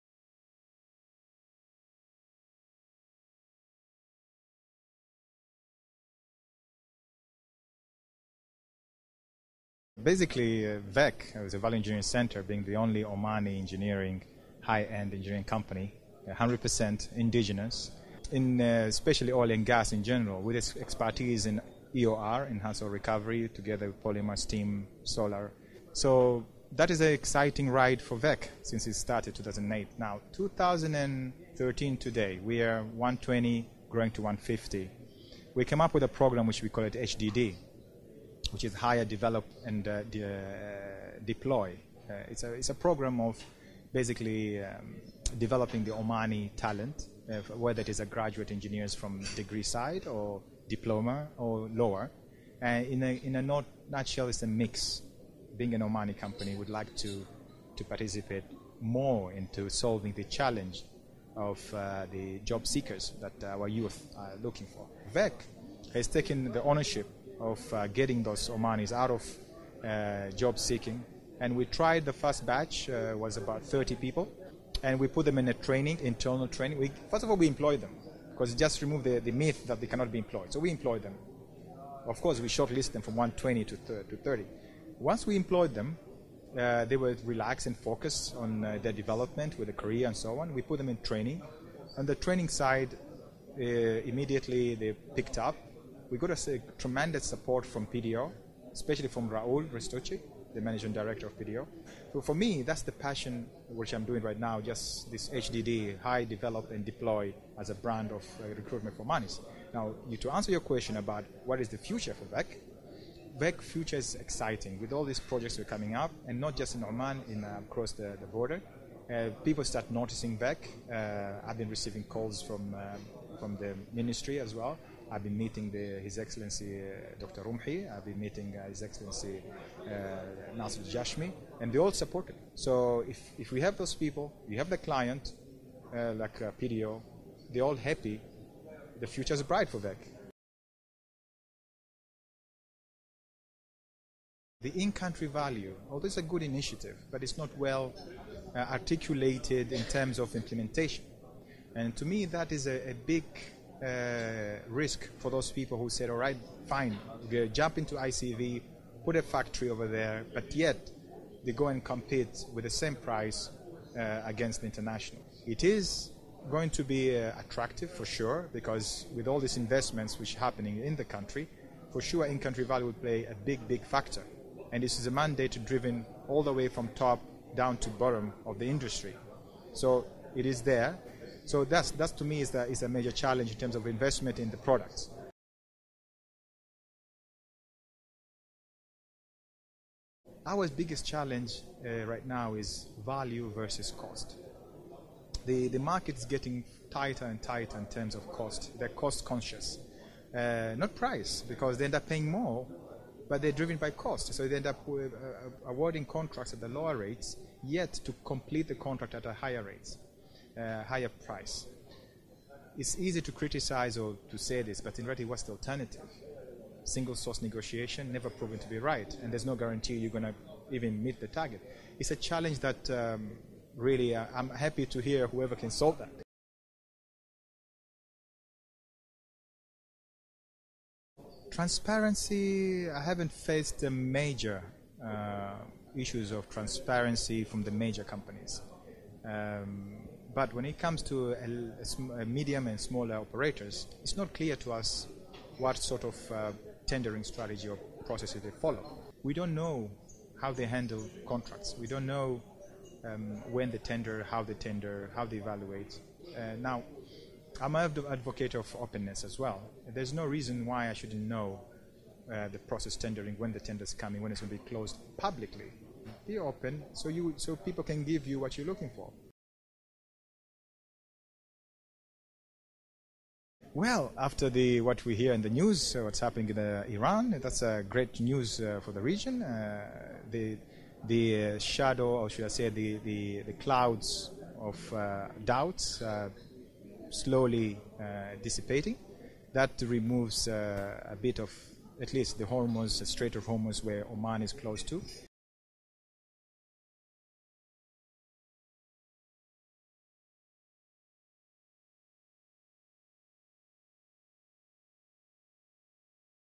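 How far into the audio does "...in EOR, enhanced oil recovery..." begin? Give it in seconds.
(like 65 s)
21 s.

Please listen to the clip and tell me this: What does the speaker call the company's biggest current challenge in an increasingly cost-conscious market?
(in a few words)
Value versus cost.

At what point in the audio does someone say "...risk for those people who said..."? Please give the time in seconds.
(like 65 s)
154 s.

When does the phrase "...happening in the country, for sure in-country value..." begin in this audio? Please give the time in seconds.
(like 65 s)
170 s.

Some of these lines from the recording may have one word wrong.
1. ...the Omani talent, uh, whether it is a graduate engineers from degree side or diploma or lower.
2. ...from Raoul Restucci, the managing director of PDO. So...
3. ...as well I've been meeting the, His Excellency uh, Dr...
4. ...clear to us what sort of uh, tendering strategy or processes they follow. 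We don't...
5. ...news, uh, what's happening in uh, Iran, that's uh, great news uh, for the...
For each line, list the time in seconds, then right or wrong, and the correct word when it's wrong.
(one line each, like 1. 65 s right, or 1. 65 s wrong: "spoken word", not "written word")
1. 45 s right
2. 99 s right
3. 124 s right
4. 244 s right
5. 275 s right.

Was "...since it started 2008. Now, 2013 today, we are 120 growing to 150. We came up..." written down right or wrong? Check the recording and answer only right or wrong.
right.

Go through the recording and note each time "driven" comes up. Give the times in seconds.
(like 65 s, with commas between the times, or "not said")
175 s, 203 s.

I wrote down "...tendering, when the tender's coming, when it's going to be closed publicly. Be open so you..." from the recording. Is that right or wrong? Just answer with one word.
right.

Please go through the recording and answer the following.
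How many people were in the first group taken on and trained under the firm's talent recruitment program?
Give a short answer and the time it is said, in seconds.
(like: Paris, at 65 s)
30, at 73 s.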